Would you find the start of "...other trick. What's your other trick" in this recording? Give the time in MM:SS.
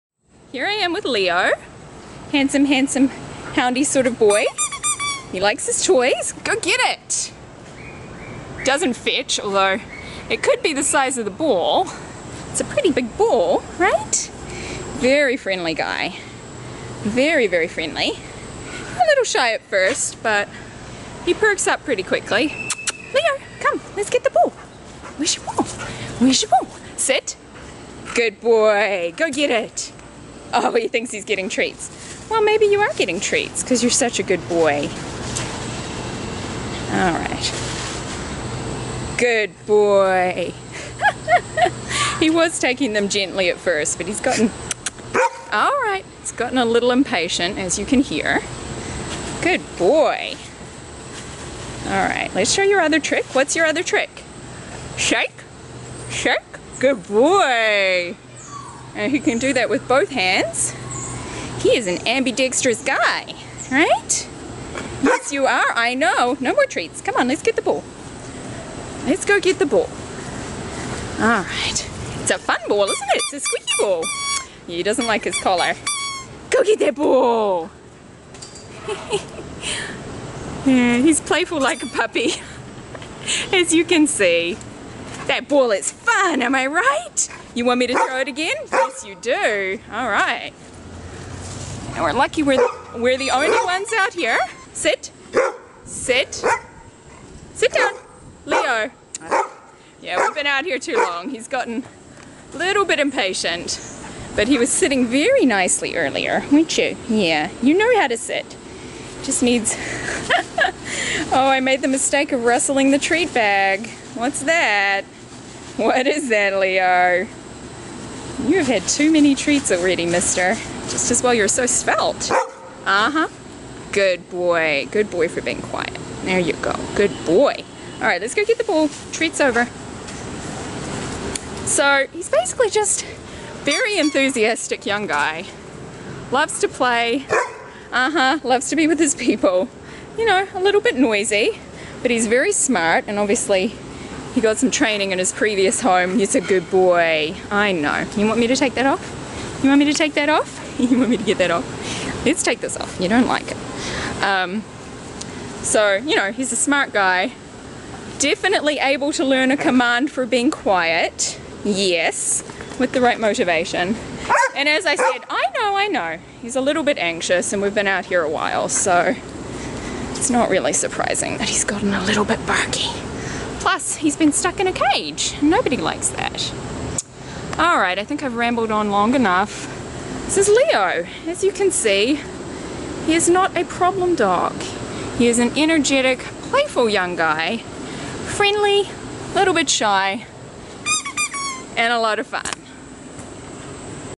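00:52.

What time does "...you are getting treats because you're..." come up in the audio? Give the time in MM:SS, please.
00:32.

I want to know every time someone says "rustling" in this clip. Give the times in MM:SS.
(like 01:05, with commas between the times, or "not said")
01:52.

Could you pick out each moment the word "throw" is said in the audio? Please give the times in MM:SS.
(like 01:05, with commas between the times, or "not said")
01:27.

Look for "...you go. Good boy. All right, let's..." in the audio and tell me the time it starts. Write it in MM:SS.
02:06.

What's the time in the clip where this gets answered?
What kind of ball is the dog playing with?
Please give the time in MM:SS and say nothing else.
01:13.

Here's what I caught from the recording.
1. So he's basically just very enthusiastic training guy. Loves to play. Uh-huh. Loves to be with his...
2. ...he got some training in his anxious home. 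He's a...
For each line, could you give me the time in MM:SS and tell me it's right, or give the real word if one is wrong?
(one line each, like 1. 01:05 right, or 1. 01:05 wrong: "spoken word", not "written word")
1. 02:11 wrong: "young", not "training"
2. 02:24 wrong: "previous", not "anxious".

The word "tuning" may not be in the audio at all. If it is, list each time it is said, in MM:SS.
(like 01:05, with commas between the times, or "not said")
not said.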